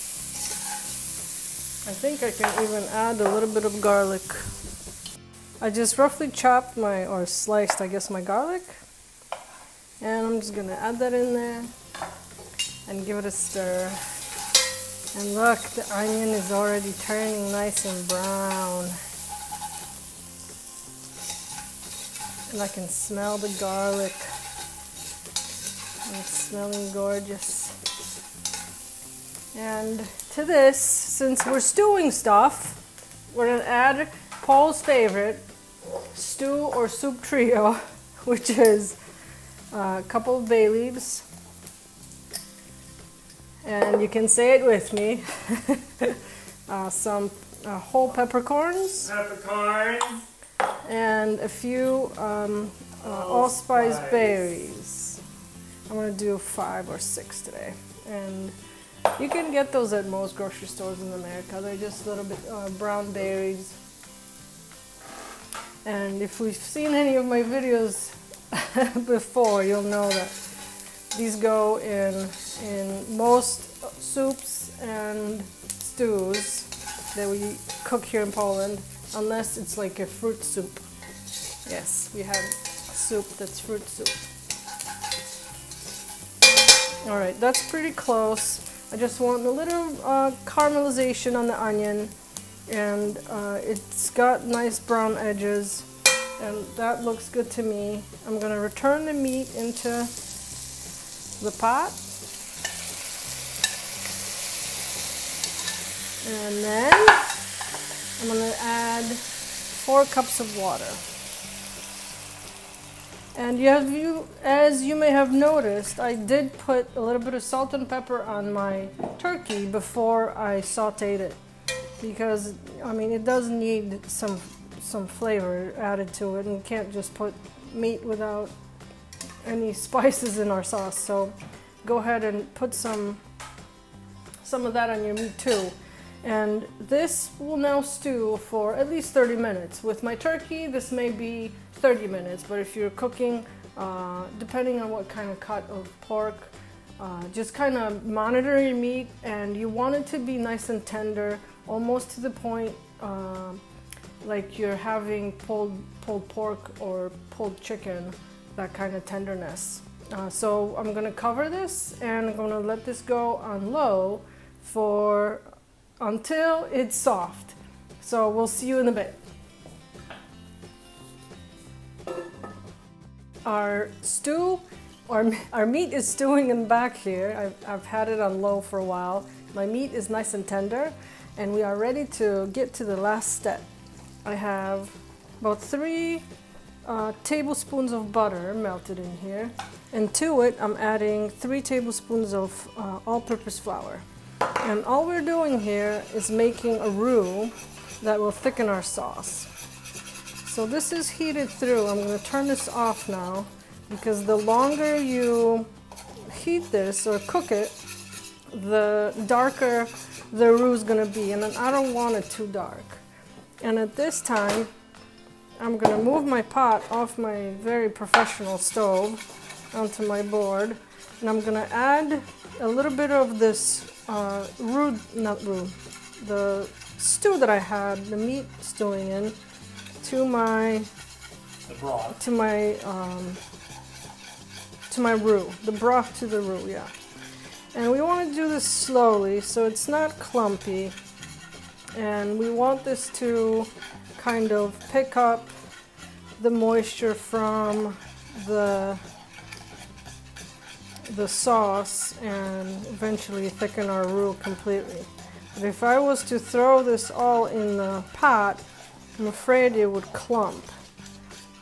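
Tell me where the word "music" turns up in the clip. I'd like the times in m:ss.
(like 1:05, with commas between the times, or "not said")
not said.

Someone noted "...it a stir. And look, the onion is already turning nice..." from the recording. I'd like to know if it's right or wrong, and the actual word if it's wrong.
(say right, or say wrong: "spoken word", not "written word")
right.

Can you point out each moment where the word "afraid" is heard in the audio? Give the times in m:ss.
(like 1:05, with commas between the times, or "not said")
4:19.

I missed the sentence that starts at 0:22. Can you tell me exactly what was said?
And I can smell the garlic.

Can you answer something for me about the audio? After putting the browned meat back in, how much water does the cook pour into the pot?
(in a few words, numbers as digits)
4 cups.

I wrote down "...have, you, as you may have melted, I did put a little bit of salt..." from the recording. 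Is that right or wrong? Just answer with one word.
wrong.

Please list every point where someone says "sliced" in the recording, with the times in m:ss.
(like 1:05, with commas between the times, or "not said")
0:07.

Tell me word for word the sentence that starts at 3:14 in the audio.
And all we're doing here is making a roux that will thicken our sauce.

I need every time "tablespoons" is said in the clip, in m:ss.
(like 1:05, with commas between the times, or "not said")
3:07, 3:11.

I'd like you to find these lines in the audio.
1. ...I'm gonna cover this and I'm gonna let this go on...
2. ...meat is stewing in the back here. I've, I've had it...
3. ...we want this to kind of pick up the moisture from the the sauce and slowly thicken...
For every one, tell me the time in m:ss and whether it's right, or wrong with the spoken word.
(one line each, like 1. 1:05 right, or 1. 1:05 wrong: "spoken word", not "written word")
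1. 2:40 right
2. 2:55 right
3. 4:02 wrong: "eventually", not "slowly".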